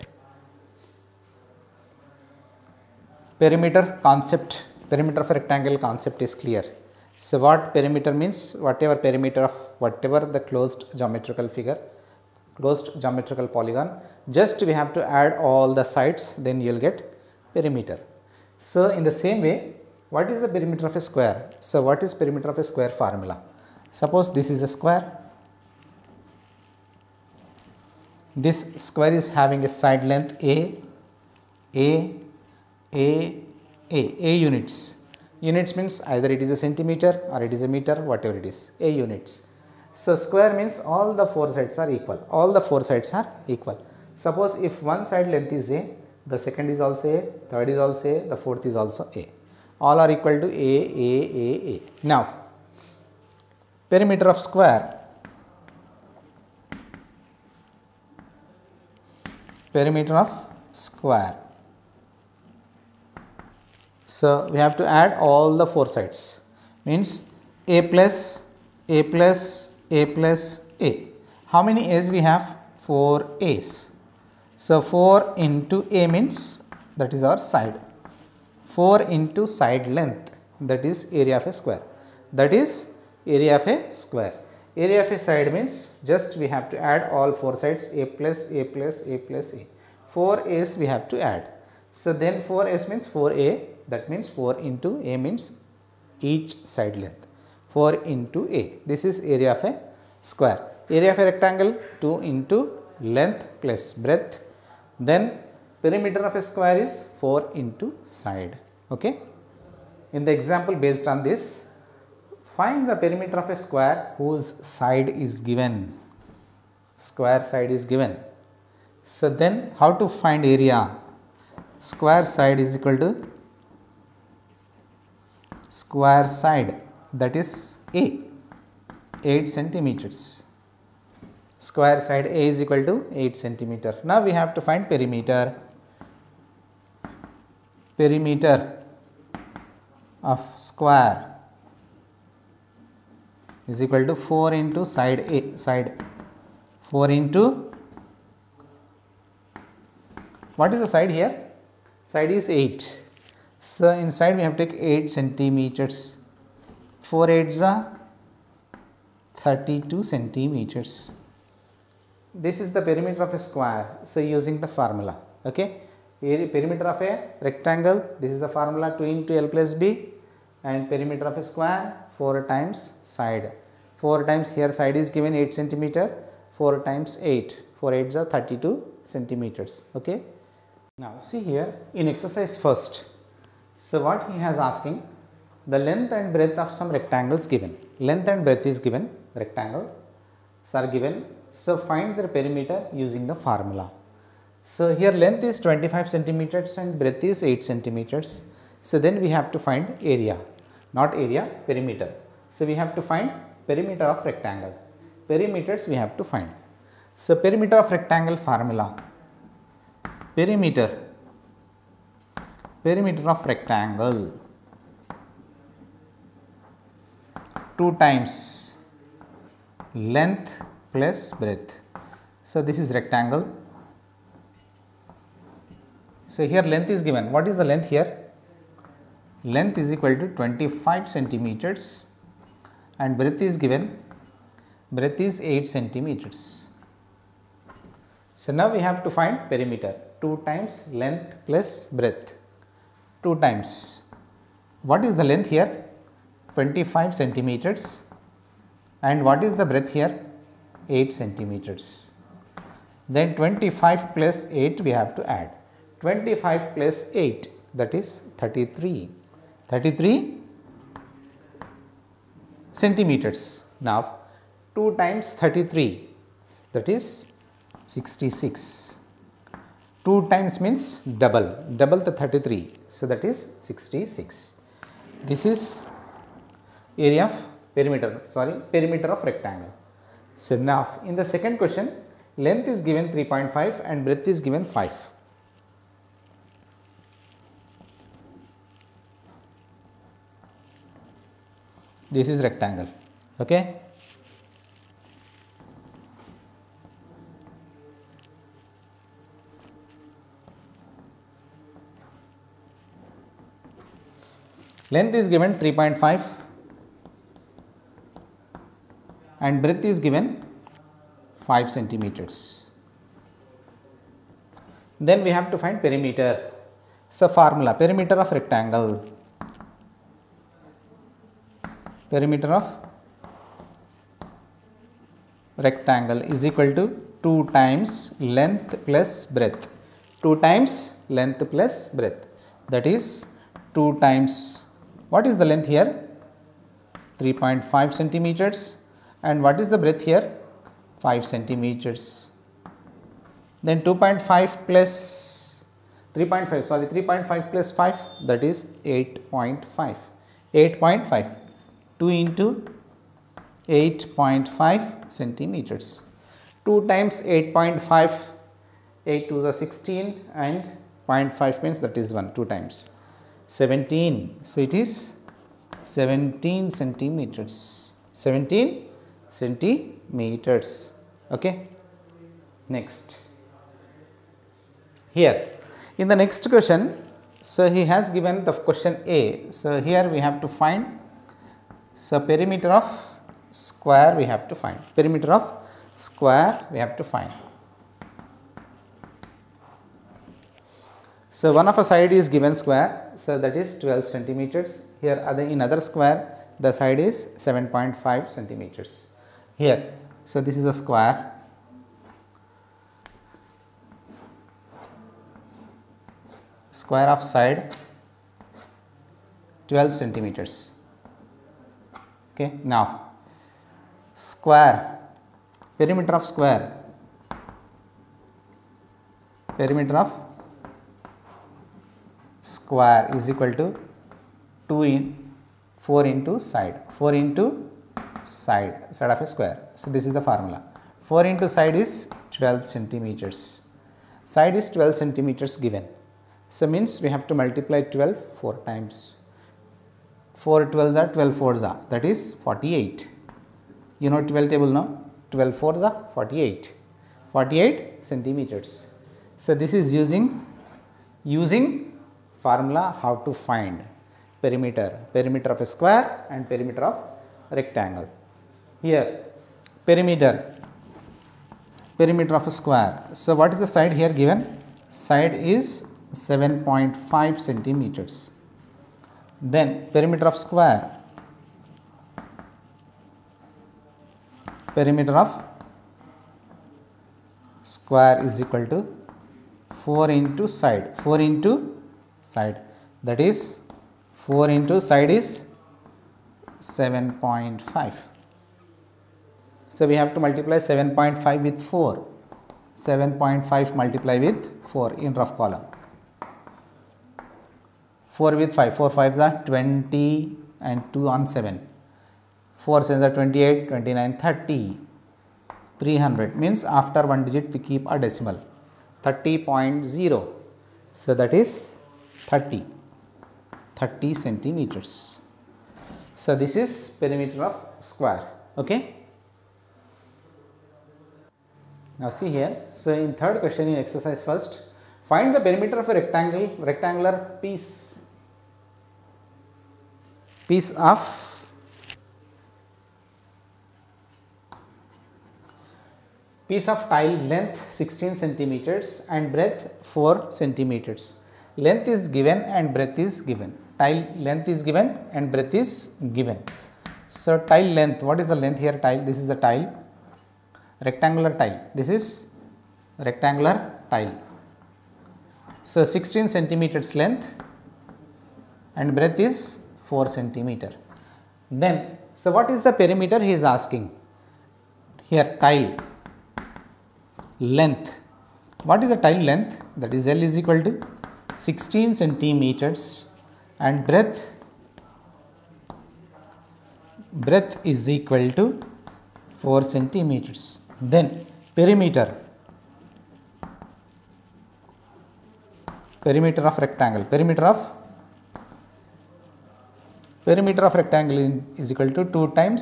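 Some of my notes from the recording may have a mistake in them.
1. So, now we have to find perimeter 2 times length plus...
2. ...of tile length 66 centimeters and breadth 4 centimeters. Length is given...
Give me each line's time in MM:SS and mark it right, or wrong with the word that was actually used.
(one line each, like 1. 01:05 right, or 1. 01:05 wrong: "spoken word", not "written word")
1. 03:58 right
2. 08:56 wrong: "16", not "66".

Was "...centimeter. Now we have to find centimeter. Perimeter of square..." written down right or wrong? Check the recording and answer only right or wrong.
wrong.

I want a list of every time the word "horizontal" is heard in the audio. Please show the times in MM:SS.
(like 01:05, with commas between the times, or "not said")
not said.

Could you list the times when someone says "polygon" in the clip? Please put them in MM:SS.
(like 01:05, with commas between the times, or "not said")
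00:13.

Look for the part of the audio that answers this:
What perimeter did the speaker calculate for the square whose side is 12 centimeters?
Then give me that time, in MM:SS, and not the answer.
07:27.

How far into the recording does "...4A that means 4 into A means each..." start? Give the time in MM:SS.
01:33.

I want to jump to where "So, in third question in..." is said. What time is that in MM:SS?
08:42.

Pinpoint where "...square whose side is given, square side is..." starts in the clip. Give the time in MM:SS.
01:53.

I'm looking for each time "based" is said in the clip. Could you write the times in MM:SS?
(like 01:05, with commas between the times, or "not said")
01:50.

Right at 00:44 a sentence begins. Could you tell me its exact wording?
Suppose if one side length is A, the second is also A, third is also A, the fourth is also A.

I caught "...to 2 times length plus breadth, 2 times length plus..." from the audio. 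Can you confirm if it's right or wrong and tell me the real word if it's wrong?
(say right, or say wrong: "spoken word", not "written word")
right.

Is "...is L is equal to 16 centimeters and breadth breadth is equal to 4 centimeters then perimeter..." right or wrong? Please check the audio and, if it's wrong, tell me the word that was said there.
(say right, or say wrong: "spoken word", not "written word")
right.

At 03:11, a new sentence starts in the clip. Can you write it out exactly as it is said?
So, find their perimeter using the formula.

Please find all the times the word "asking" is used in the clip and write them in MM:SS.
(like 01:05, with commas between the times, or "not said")
03:04, 09:23.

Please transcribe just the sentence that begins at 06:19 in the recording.
So here we have to find so perimeter of square we have to find perimeter of square we have to find.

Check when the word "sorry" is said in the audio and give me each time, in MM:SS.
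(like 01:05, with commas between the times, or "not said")
04:38.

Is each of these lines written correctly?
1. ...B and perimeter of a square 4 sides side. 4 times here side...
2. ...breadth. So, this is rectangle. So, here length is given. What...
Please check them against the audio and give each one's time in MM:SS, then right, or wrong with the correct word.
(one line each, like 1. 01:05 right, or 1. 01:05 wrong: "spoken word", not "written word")
1. 02:49 wrong: "times", not "sides"
2. 03:41 right.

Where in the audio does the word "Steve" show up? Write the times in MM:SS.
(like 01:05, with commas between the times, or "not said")
not said.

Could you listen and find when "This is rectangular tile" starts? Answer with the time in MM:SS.
09:11.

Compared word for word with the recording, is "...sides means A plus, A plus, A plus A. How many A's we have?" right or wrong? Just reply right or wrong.
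right.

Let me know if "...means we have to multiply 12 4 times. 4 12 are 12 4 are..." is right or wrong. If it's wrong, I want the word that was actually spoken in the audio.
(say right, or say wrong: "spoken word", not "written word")
right.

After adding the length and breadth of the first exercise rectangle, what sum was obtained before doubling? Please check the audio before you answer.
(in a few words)
33.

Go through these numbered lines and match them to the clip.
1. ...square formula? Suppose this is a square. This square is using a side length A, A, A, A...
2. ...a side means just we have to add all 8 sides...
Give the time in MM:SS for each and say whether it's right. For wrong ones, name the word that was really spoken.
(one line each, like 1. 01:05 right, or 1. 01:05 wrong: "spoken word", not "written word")
1. 00:22 wrong: "having", not "using"
2. 01:25 wrong: "4", not "8".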